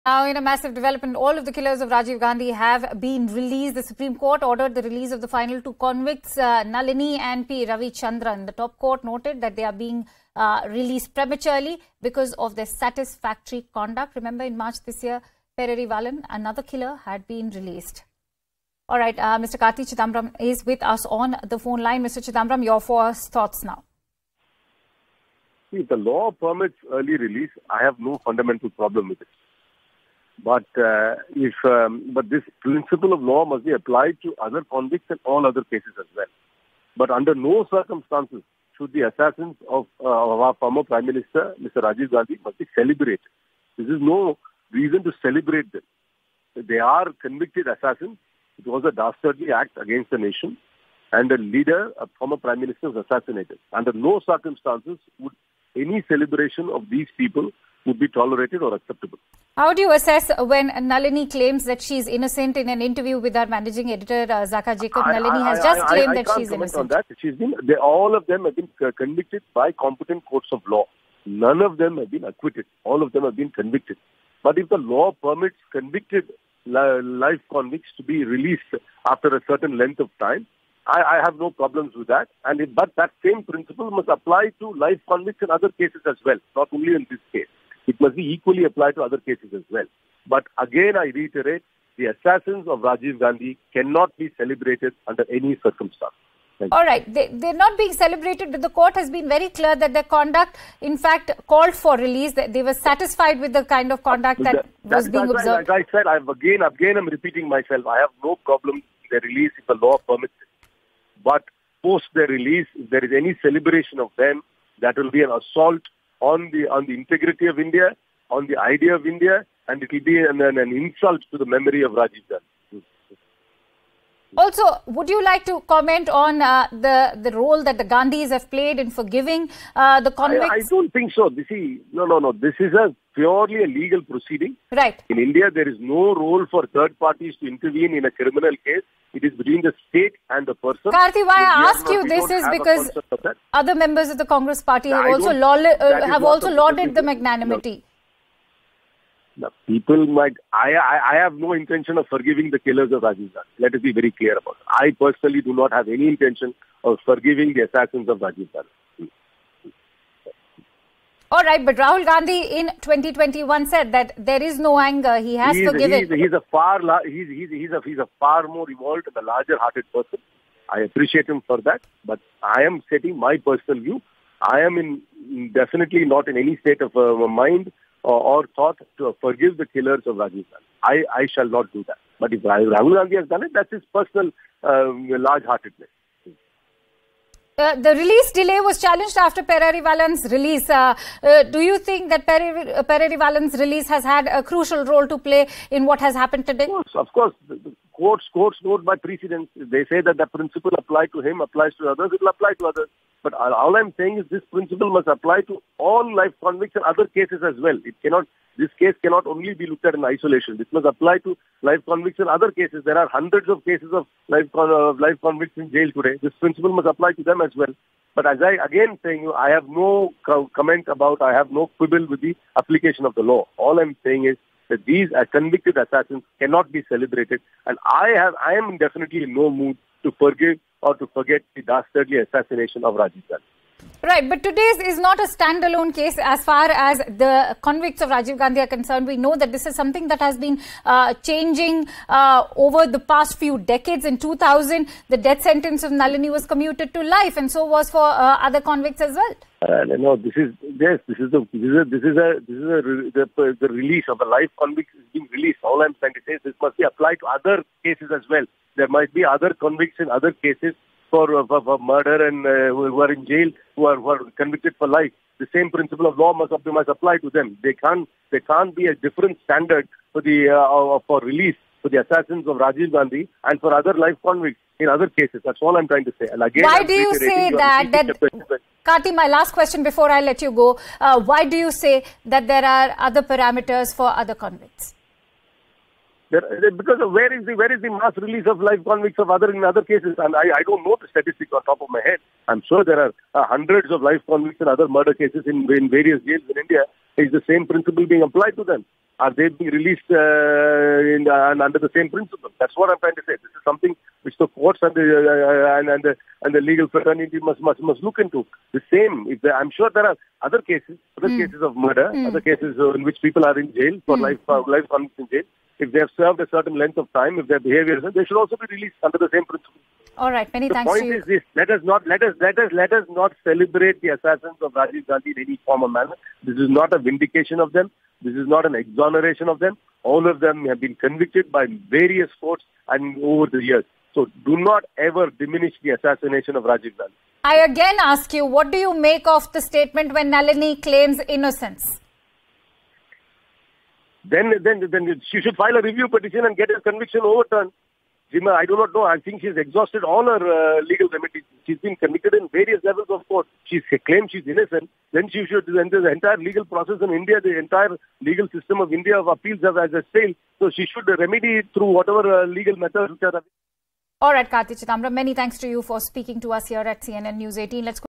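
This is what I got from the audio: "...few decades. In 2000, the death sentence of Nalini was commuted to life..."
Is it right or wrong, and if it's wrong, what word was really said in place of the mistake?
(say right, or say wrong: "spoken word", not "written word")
right.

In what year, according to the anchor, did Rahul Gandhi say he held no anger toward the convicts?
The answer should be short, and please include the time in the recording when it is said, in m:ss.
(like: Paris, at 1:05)
2021, at 2:42.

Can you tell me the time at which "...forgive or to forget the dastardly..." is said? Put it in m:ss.
3:50.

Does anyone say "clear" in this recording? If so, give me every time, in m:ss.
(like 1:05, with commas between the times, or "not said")
1:39, 2:34.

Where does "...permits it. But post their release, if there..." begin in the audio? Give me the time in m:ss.
1:50.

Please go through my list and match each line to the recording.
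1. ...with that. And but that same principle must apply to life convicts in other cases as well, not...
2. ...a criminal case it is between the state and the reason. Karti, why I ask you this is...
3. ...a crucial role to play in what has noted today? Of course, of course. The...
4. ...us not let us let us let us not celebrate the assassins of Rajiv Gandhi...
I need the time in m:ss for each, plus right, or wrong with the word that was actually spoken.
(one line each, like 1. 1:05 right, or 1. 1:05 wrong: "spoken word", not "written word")
1. 1:21 right
2. 2:18 wrong: "person", not "reason"
3. 3:14 wrong: "happened", not "noted"
4. 5:21 right.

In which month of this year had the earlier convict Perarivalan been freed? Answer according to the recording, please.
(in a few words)
March.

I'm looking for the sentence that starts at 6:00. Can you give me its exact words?
So she should remedy through whatever uh, legal methods which are.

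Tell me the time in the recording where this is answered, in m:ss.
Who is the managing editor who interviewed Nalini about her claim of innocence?
1:04.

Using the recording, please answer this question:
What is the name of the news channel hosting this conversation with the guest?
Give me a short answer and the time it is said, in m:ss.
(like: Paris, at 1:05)
CNN News 18, at 6:07.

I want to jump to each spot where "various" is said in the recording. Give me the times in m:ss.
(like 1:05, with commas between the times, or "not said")
4:55, 5:31, 5:52.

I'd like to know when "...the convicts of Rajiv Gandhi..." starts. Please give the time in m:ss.
3:57.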